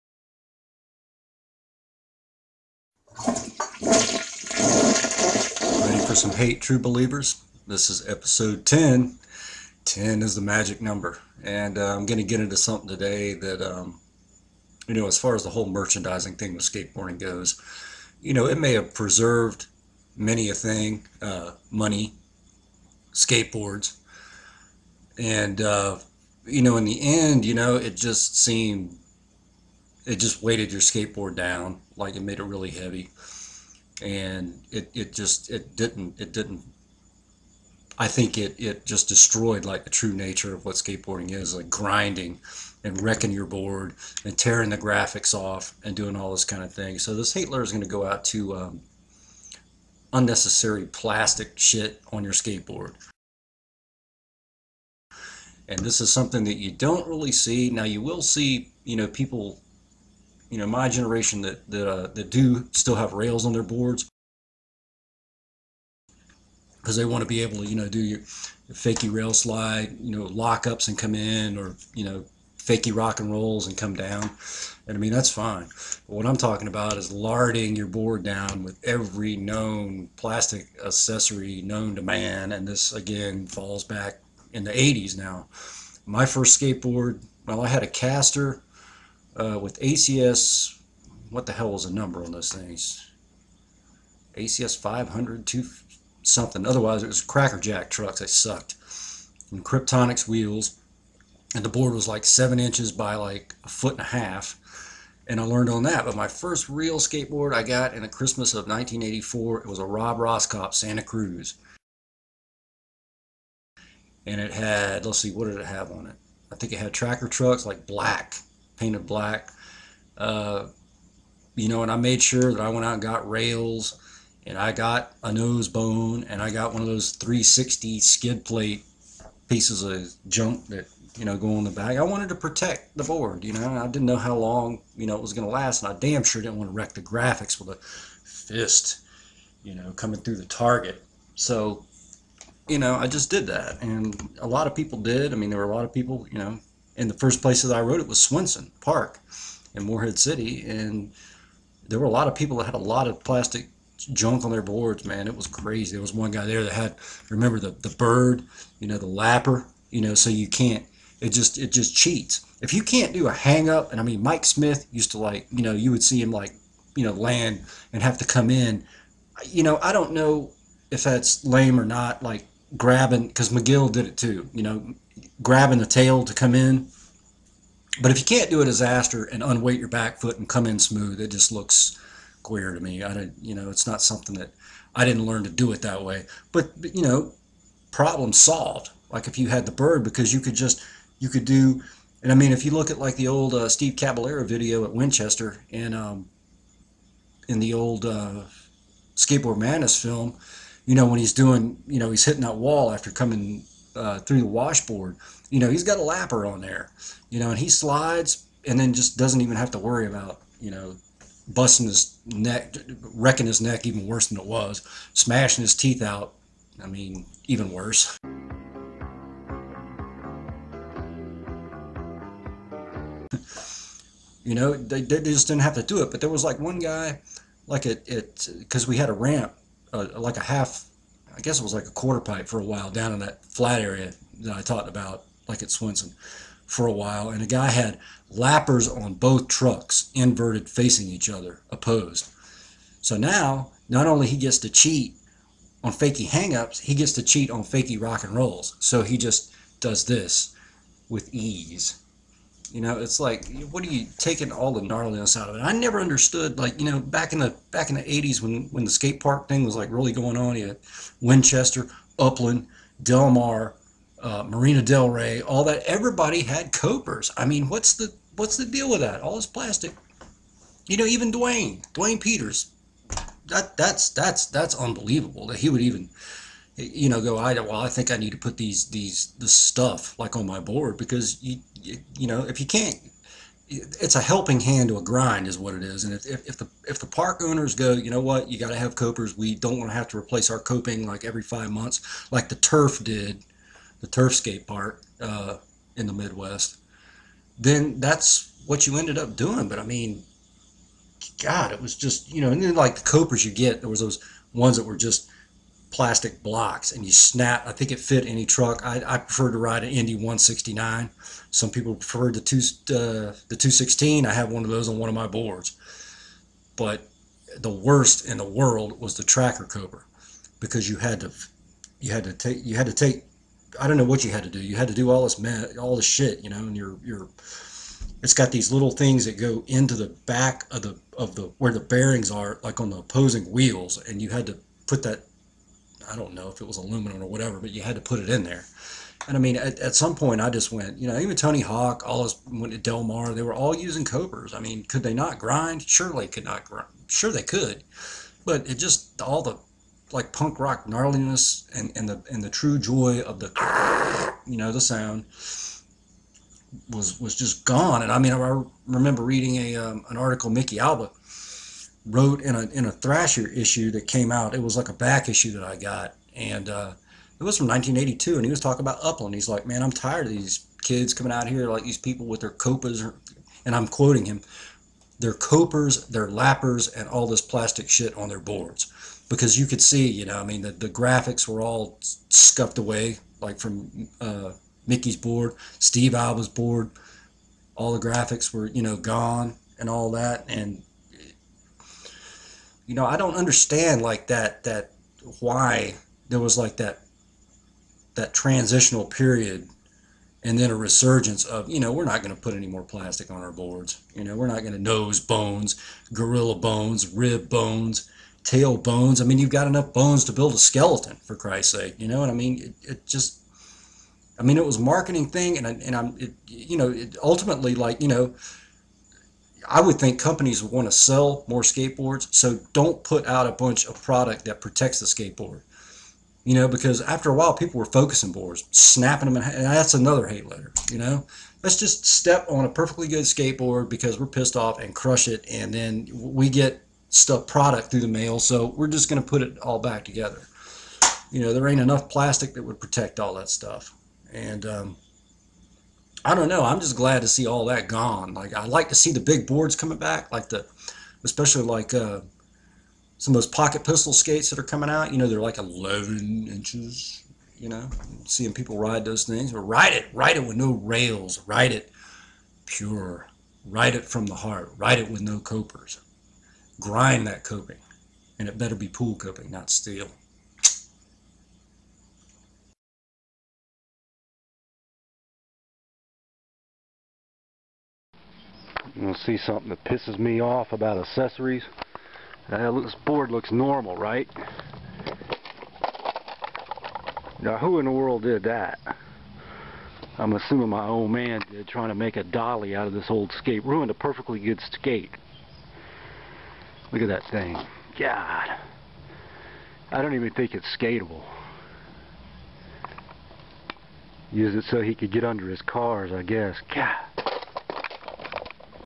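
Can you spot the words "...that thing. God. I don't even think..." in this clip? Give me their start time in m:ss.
8:17.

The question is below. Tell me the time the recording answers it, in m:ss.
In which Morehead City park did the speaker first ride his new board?
2:28.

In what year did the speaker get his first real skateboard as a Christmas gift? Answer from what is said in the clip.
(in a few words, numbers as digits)
1984.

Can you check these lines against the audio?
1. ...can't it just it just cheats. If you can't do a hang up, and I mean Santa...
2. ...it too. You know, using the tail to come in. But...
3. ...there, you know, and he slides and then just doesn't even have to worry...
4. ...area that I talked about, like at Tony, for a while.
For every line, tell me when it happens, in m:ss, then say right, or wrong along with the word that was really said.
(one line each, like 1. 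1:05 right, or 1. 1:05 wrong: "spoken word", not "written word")
1. 2:40 wrong: "Mike", not "Santa"
2. 2:54 wrong: "grabbing", not "using"
3. 3:26 right
4. 3:53 wrong: "Swenson", not "Tony".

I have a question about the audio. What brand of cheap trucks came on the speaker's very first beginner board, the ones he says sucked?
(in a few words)
Crackerjack.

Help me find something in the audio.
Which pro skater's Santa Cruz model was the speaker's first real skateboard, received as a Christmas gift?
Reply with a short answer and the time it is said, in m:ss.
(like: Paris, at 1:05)
Rob Roskopp, at 1:49.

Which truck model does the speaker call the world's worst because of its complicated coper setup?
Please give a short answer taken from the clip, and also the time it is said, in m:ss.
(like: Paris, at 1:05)
Tracker Cobra, at 5:19.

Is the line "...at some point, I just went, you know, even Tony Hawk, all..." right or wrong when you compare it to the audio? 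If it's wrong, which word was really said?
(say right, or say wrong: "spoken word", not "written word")
right.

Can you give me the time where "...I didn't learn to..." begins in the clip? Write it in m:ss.
3:04.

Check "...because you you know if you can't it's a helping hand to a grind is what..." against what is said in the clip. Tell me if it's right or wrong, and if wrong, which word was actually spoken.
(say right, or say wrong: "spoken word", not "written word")
right.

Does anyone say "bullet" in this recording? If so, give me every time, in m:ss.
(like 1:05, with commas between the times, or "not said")
not said.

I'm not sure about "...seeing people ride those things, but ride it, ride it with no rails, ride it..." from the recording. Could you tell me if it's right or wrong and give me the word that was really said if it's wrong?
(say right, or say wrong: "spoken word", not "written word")
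right.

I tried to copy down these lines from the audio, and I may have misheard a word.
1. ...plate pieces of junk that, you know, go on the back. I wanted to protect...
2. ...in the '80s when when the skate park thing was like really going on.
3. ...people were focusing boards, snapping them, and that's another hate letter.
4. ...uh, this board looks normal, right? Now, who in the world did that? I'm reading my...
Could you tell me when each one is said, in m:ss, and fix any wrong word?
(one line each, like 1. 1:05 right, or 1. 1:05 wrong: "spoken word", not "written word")
1. 2:08 right
2. 4:17 right
3. 7:07 right
4. 8:02 wrong: "assuming", not "reading".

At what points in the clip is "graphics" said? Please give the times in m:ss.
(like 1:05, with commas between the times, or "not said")
0:44, 2:17, 6:20, 6:28.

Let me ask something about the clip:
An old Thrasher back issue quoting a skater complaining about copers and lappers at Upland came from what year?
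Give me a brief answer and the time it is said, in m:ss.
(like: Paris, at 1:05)
1982, at 6:07.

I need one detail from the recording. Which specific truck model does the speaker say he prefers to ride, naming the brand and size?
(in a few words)
Indy 169.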